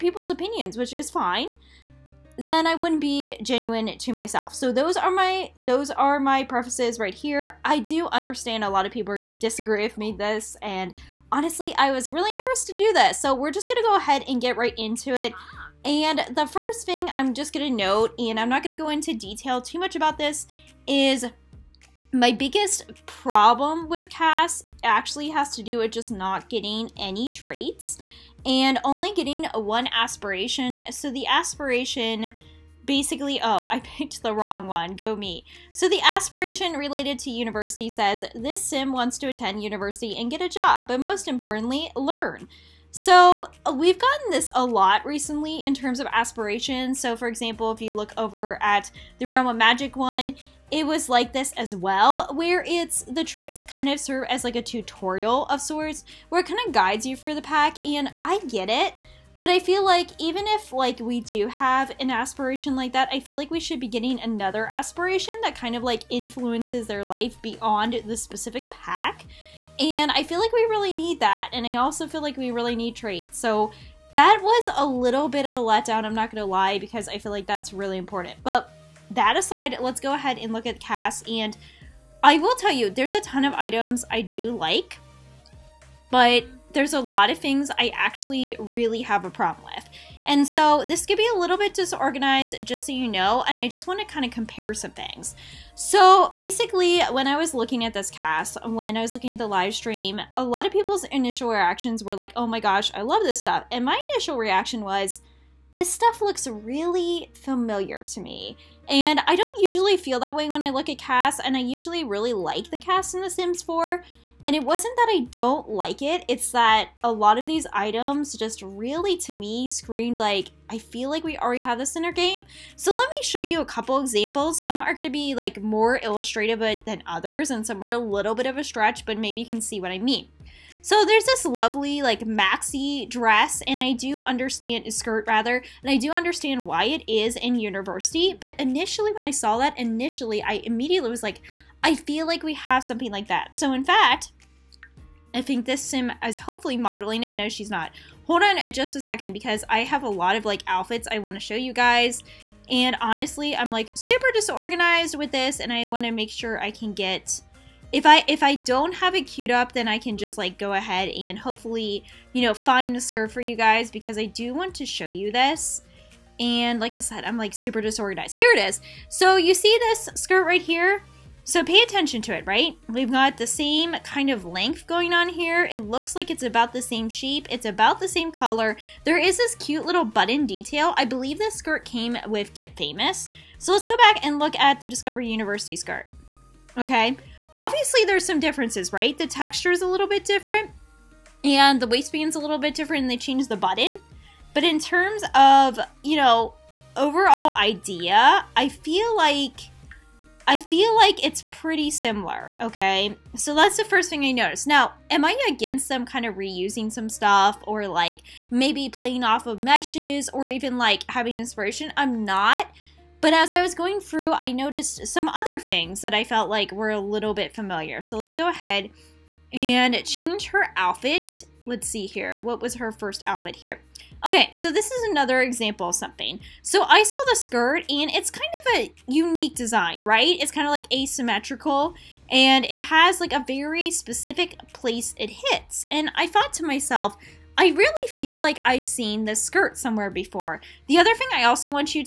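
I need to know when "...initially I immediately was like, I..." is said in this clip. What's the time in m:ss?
2:19.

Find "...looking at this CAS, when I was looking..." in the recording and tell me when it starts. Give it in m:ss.
1:37.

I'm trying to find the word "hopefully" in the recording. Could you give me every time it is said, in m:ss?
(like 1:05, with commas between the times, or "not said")
2:26, 2:41.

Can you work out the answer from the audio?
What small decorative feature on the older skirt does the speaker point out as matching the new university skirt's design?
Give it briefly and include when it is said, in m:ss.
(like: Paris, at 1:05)
button detail, at 3:00.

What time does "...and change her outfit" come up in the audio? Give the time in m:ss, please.
3:39.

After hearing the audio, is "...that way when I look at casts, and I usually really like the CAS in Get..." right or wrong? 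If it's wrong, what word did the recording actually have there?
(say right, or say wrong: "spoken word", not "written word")
wrong: "The", not "Get".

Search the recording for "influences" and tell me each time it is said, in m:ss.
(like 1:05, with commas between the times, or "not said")
1:06.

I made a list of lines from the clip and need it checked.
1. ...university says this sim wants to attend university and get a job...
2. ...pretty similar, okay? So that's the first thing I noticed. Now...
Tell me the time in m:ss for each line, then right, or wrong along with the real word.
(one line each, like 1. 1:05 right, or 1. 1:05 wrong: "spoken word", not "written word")
1. 0:37 right
2. 3:21 right.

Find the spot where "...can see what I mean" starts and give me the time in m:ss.
2:09.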